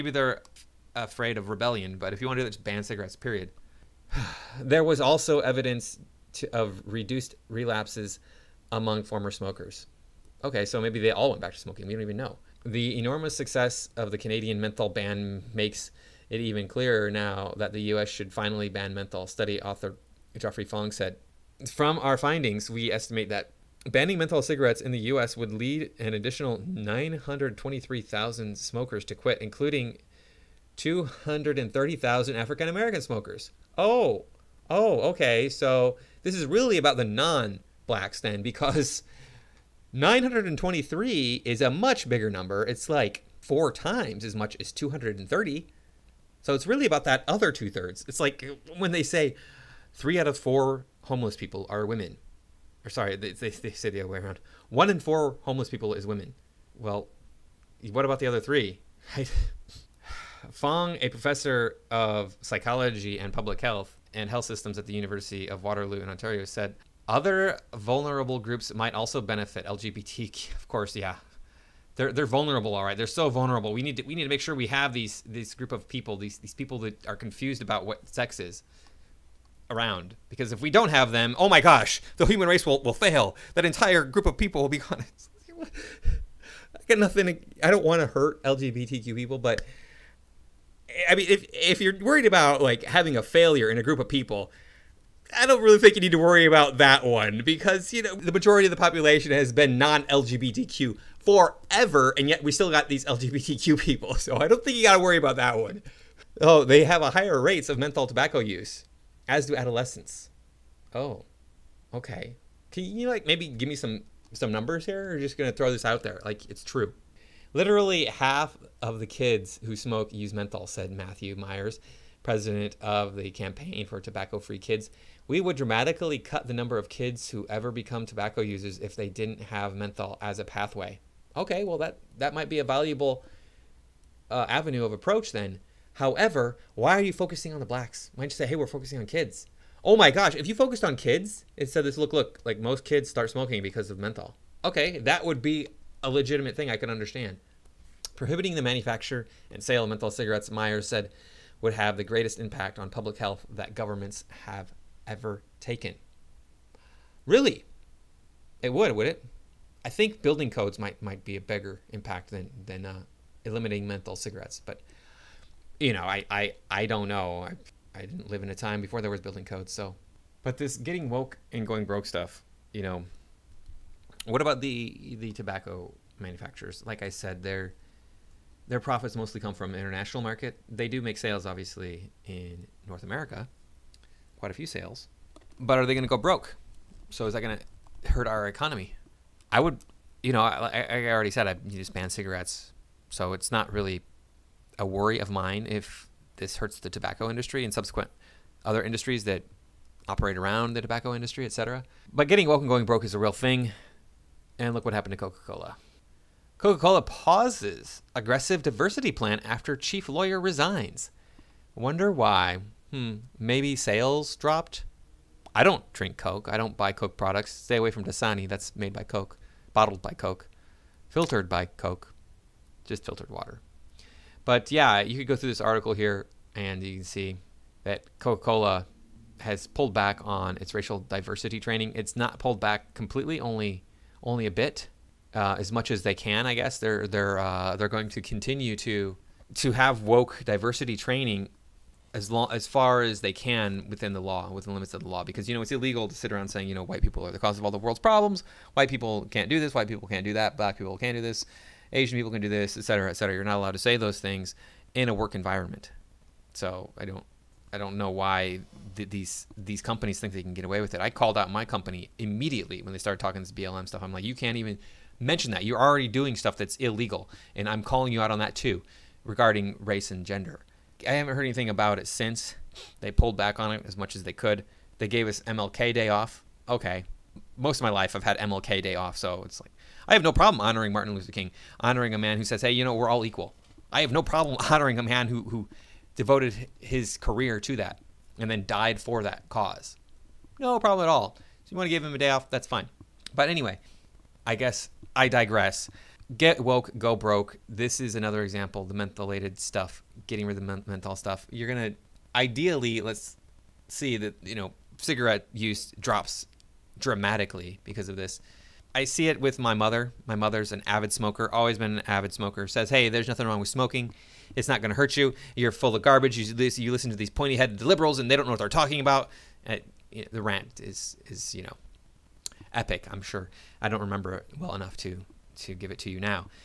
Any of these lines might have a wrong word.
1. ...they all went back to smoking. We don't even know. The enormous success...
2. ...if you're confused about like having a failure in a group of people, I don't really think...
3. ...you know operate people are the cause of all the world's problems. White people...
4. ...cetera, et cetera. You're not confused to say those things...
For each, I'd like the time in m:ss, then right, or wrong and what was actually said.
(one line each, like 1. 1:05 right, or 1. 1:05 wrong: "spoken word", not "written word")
1. 0:10 right
2. 1:31 wrong: "worried", not "confused"
3. 4:06 wrong: "white", not "operate"
4. 4:12 wrong: "allowed", not "confused".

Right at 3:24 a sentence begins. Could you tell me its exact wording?
And look what happened to Coca Cola.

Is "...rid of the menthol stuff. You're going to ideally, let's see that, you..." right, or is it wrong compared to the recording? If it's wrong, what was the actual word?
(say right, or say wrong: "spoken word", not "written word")
right.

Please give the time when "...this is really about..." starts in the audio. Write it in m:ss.
0:36.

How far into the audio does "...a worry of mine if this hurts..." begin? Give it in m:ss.
3:14.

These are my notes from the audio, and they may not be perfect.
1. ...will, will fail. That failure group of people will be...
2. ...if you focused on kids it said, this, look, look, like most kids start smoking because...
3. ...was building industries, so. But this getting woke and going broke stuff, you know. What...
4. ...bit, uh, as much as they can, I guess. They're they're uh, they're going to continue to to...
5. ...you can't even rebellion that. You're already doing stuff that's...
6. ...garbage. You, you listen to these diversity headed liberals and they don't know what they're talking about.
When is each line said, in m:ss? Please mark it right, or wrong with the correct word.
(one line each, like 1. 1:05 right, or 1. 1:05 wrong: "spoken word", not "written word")
1. 1:22 wrong: "entire", not "failure"
2. 2:20 right
3. 2:49 wrong: "codes", not "industries"
4. 3:54 right
5. 4:24 wrong: "mention", not "rebellion"
6. 5:16 wrong: "pointy", not "diversity".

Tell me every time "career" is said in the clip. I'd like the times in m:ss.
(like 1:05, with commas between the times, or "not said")
4:47.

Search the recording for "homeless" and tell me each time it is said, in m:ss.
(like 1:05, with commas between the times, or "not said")
0:51, 0:55.